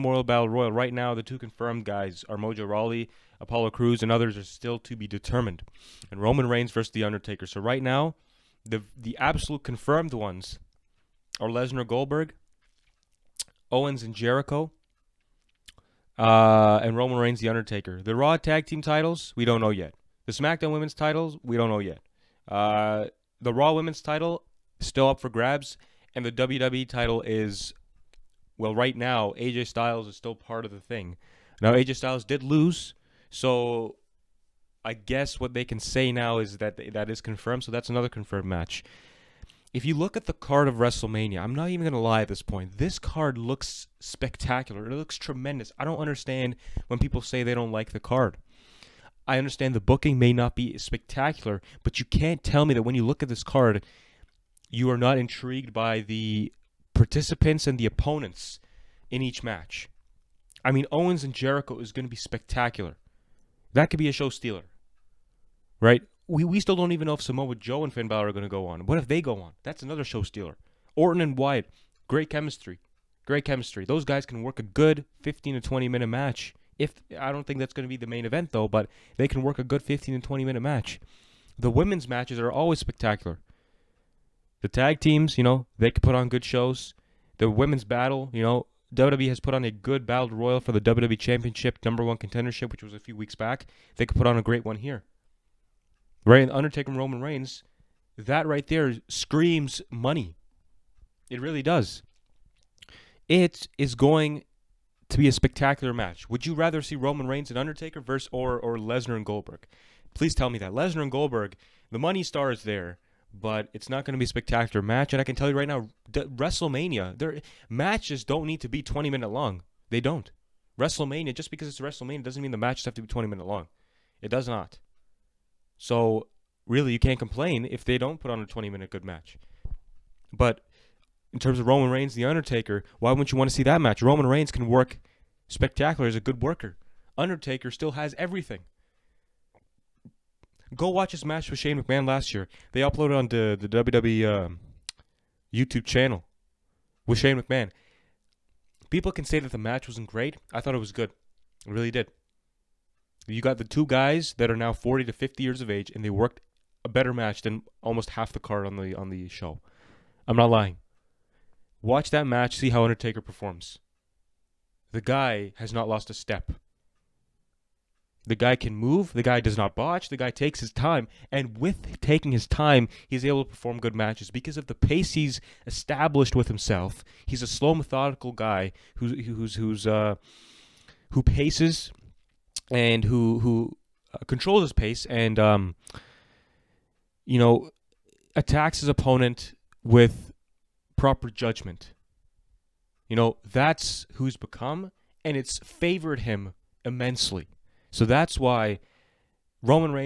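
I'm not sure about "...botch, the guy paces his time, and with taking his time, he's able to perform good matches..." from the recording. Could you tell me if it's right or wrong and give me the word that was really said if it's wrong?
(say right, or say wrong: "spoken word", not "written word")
wrong: "takes", not "paces".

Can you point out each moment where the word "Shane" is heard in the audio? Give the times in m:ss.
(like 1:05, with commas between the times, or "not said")
2:21, 2:27.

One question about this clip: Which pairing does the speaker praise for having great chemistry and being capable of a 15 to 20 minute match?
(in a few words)
Orton and Wyatt.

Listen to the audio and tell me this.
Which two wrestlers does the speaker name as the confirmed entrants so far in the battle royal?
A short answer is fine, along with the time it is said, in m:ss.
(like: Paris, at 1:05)
Mojo Rawley, Apollo Crews, at 0:02.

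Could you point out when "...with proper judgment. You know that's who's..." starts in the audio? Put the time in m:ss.
3:09.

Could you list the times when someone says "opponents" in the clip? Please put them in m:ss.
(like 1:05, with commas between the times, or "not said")
0:57, 3:08.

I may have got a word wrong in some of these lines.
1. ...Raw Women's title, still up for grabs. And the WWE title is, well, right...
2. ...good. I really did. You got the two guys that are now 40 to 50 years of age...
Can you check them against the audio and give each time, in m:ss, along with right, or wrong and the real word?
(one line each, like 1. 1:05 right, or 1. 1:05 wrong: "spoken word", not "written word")
1. 0:23 right
2. 2:30 right.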